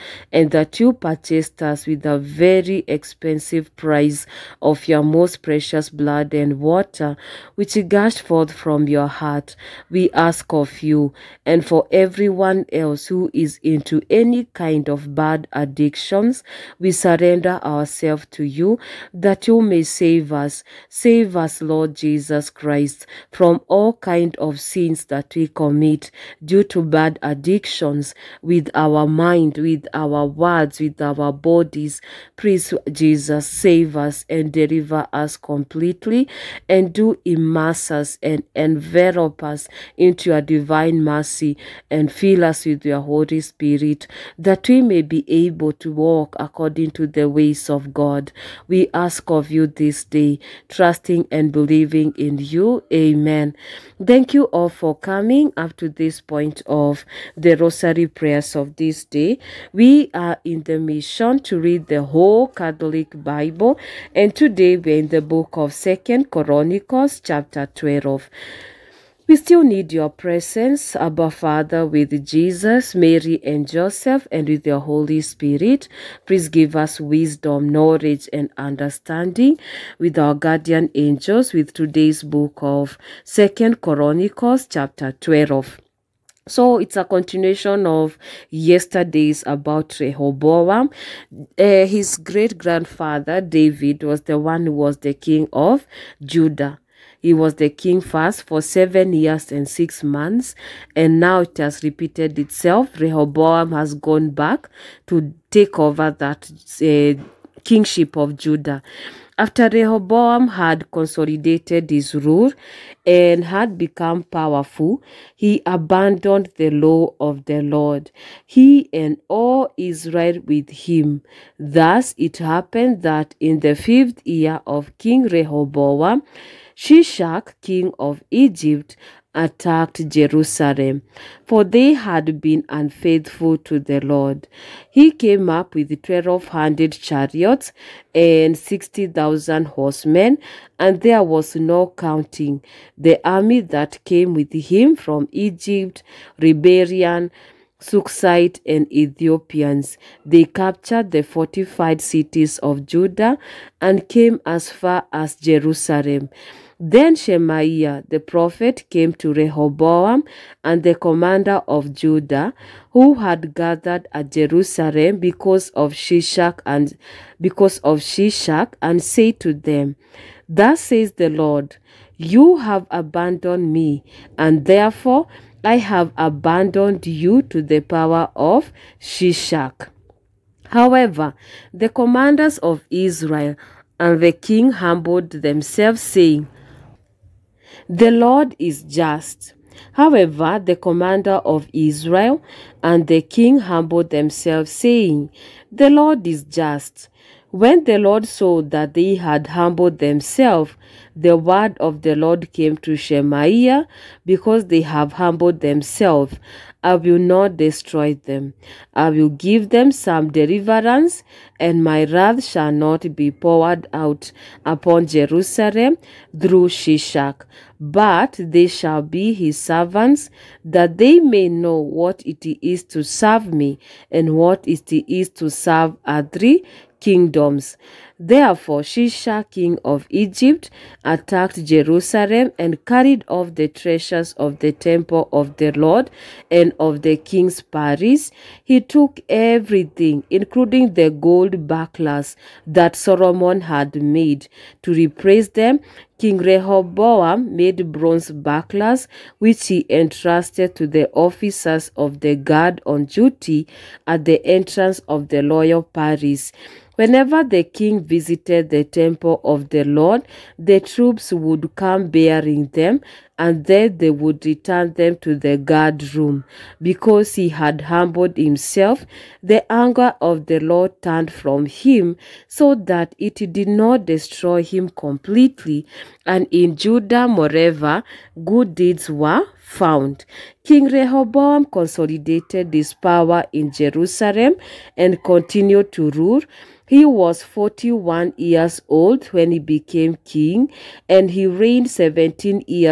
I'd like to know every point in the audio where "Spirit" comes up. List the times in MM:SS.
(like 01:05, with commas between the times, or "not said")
00:43, 01:15.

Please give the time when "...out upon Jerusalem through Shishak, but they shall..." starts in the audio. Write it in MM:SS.
03:33.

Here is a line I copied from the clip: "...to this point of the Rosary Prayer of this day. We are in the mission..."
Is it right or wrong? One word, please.
right.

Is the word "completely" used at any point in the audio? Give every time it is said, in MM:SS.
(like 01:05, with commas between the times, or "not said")
00:35, 04:34.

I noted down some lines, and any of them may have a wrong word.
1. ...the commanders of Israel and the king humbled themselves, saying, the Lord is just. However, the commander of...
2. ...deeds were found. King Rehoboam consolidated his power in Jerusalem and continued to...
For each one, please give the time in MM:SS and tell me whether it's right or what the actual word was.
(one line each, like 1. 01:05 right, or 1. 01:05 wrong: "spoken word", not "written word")
1. 03:01 right
2. 04:38 right.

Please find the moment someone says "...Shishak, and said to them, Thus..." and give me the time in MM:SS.
02:48.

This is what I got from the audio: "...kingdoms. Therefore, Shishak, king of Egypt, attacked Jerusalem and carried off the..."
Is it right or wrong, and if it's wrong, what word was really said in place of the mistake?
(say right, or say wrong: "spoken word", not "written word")
right.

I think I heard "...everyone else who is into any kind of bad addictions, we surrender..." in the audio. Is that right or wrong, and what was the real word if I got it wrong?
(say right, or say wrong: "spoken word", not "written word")
right.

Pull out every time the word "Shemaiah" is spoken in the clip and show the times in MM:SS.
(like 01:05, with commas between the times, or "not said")
02:37, 03:22.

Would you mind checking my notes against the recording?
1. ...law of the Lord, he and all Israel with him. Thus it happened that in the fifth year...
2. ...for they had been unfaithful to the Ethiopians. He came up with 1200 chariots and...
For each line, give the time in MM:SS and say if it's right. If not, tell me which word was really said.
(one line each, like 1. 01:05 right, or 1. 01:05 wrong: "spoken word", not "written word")
1. 01:56 right
2. 02:11 wrong: "Lord", not "Ethiopians".